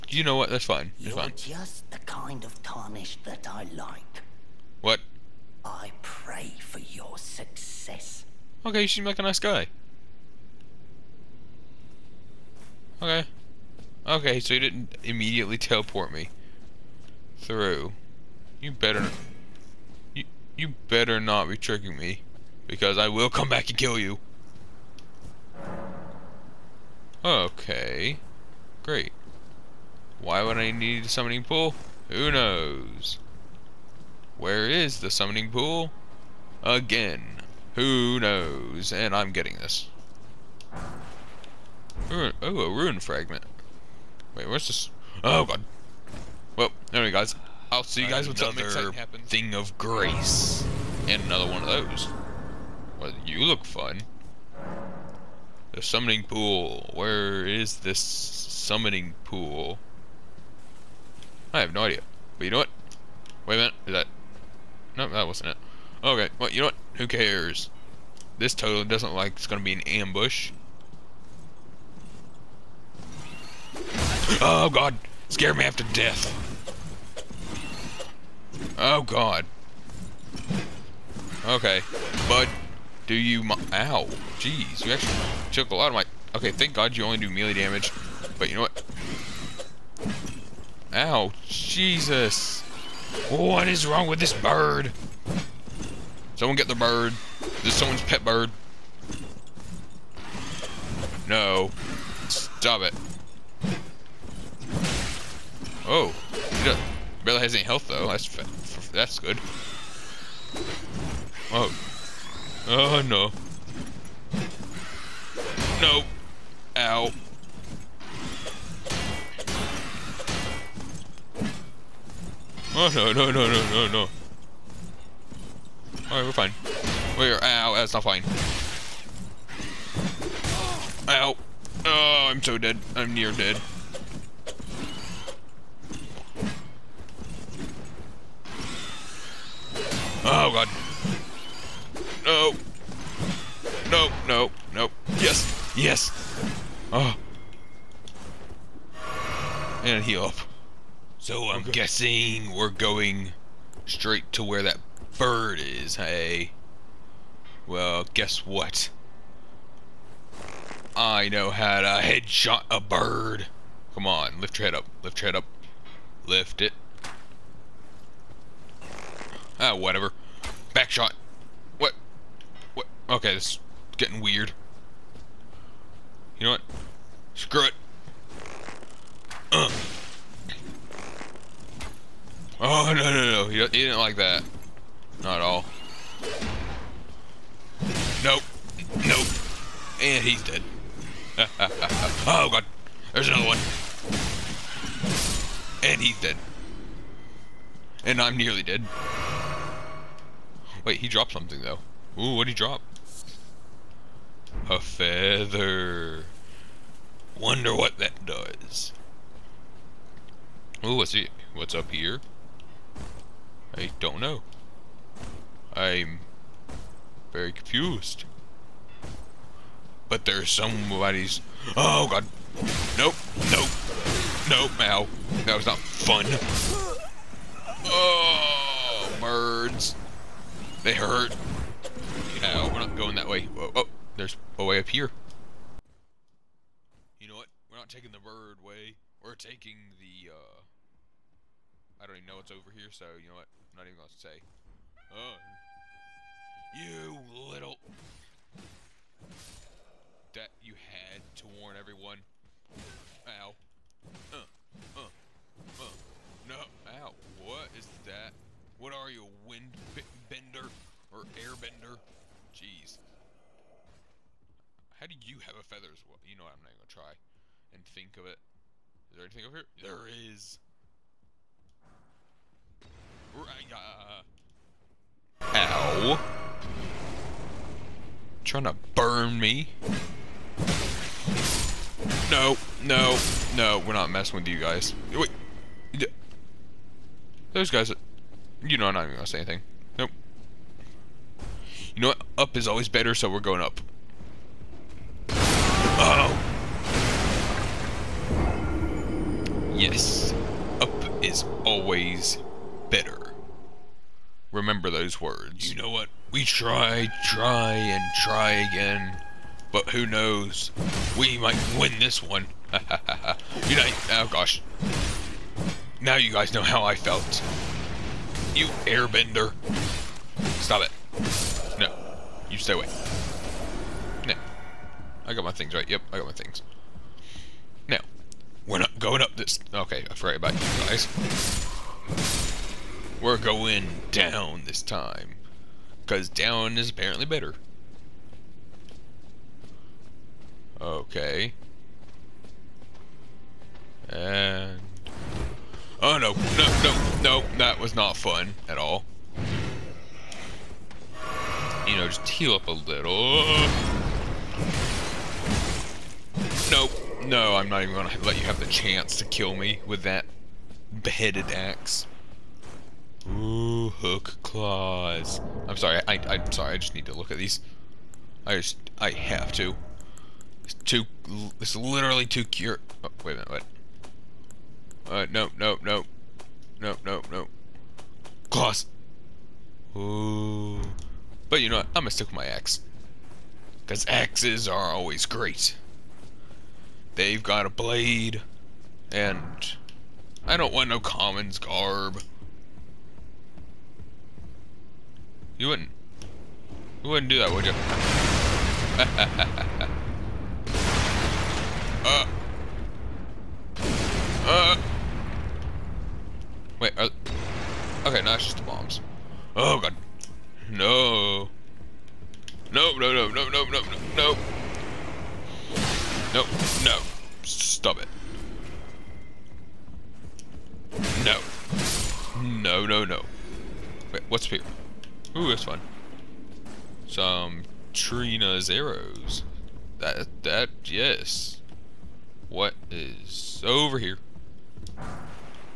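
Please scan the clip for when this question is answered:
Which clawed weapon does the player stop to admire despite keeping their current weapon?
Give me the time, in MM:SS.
06:03.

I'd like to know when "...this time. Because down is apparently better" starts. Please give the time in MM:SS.
05:34.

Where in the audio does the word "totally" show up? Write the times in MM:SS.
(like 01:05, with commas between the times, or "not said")
01:08.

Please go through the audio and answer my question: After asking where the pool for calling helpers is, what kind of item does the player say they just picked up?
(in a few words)
Ruin fragment.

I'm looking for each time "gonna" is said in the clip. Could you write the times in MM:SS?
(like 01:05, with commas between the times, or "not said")
01:09, 04:03, 04:26, 04:49, 05:57, 06:22.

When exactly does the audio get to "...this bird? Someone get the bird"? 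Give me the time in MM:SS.
01:34.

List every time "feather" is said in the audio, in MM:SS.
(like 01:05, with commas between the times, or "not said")
03:24, 04:25.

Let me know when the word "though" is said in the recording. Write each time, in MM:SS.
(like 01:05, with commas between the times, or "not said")
01:47, 03:21.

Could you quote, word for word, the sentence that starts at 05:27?
Now, we're not going up this...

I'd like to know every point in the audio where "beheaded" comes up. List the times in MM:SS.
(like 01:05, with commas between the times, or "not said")
06:01.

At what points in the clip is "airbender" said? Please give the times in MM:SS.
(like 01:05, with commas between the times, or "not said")
04:21, 05:18.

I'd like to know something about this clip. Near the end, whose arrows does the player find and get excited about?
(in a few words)
Trina's.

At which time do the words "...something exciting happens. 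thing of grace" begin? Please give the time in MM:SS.
00:48.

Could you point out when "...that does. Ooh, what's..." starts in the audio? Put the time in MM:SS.
03:27.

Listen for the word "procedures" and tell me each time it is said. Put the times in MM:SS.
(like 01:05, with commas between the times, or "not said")
not said.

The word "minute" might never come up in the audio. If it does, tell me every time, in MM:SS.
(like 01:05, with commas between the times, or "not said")
01:03, 06:13.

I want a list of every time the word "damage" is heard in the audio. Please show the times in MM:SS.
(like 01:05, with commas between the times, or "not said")
01:27.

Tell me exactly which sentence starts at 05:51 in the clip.
You know, just heal up a little.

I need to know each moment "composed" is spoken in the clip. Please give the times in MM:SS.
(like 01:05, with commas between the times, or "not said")
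not said.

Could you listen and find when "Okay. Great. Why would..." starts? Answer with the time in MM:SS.
00:27.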